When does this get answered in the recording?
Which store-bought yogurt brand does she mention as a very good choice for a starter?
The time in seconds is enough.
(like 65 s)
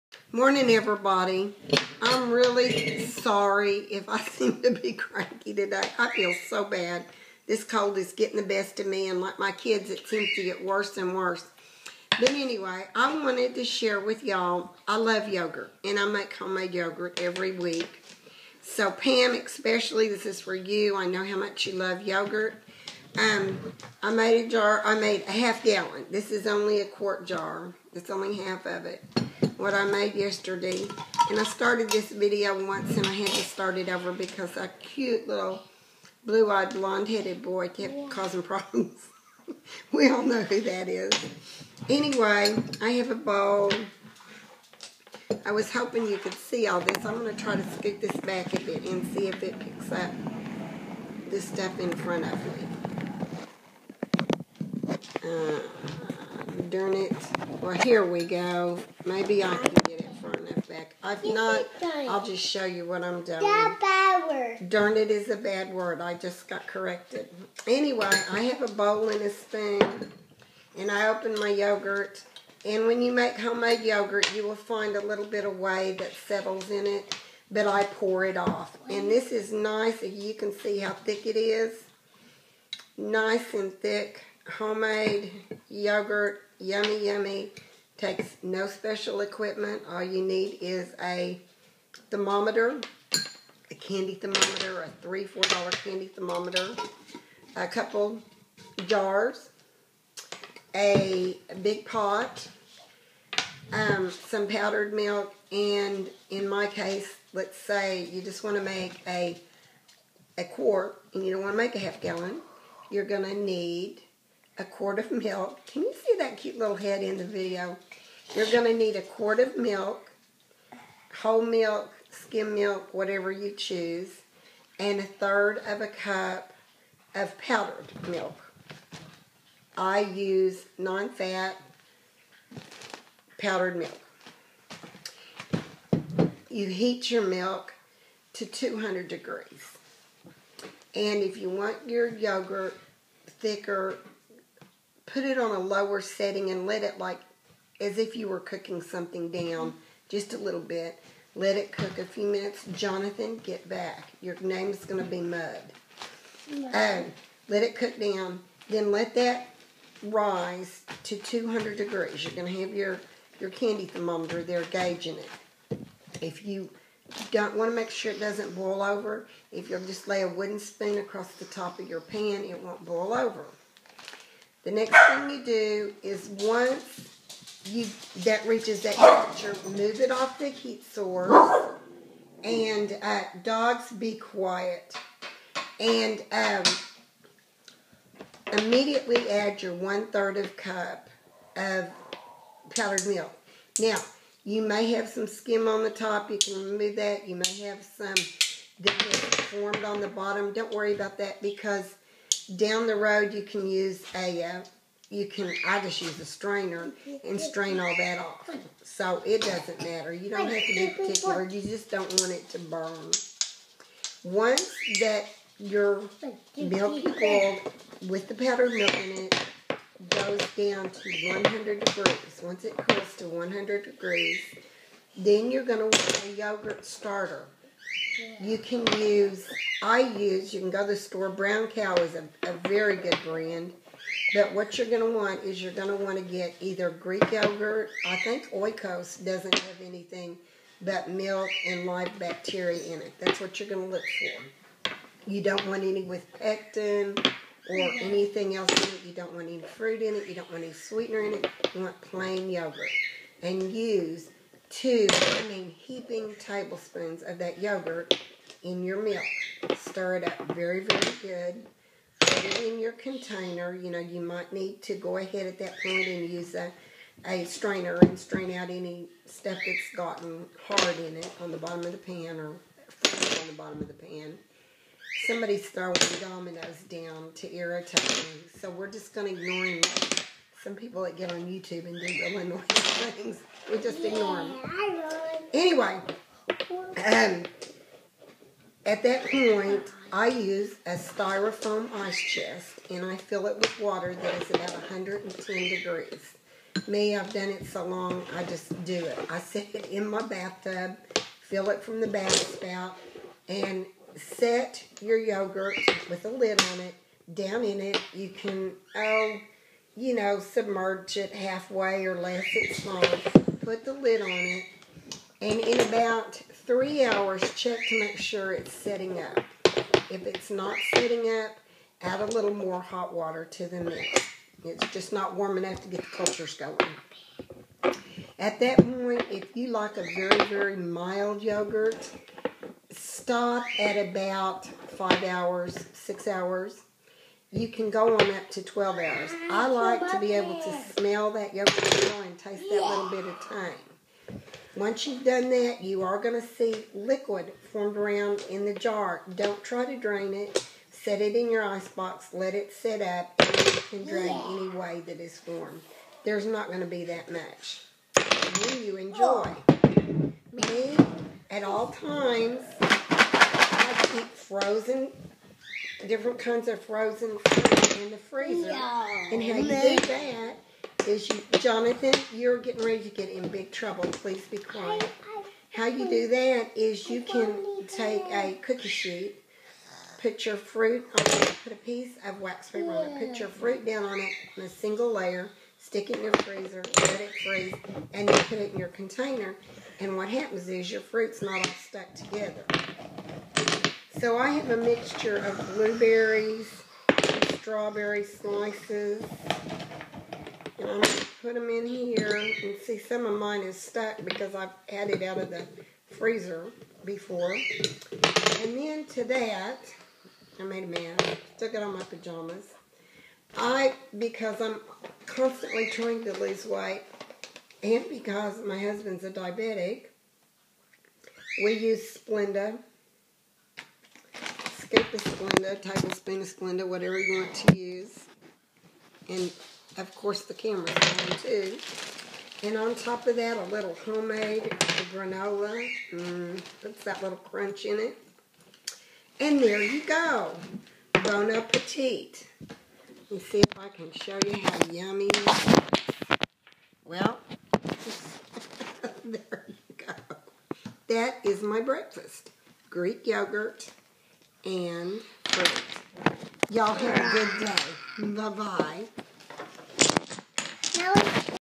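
231 s.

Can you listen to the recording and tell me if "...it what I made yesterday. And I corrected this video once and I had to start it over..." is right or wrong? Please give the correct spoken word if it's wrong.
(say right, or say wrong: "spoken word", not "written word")
wrong: "started", not "corrected".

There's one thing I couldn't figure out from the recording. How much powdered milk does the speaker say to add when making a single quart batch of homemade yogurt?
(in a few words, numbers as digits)
1/3 cup.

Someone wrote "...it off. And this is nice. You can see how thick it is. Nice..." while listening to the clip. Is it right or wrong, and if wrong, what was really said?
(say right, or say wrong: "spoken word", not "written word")
right.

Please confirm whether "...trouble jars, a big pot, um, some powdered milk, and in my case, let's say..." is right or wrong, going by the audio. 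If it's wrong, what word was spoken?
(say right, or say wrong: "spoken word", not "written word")
wrong: "couple", not "trouble".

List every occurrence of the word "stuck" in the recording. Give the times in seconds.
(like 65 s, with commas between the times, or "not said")
391 s, 403 s.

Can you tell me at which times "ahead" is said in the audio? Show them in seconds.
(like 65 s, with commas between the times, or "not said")
265 s.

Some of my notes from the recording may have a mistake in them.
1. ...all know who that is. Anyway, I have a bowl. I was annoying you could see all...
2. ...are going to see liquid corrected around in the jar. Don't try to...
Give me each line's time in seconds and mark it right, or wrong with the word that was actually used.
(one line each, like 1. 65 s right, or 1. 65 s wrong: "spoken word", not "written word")
1. 40 s wrong: "hoping", not "annoying"
2. 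346 s wrong: "formed", not "corrected".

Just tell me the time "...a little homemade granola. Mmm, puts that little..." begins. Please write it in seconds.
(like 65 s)
433 s.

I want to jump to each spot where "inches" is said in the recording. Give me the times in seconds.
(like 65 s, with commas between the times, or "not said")
not said.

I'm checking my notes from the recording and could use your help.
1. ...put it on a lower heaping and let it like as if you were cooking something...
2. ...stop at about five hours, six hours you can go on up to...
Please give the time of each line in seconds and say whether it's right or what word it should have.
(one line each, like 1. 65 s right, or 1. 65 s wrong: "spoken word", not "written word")
1. 145 s wrong: "setting", not "heaping"
2. 332 s right.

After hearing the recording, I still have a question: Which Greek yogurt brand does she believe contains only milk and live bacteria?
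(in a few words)
Oikos.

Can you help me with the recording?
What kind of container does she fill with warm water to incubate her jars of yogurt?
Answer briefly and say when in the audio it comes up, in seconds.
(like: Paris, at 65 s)
styrofoam ice chest, at 290 s.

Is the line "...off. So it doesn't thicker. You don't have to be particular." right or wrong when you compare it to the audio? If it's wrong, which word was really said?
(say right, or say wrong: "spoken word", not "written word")
wrong: "matter", not "thicker".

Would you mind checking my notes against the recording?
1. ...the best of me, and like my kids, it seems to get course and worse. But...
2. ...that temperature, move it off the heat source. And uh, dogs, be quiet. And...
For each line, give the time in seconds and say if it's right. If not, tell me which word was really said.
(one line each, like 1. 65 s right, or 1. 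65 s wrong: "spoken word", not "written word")
1. 8 s wrong: "worse", not "course"
2. 178 s right.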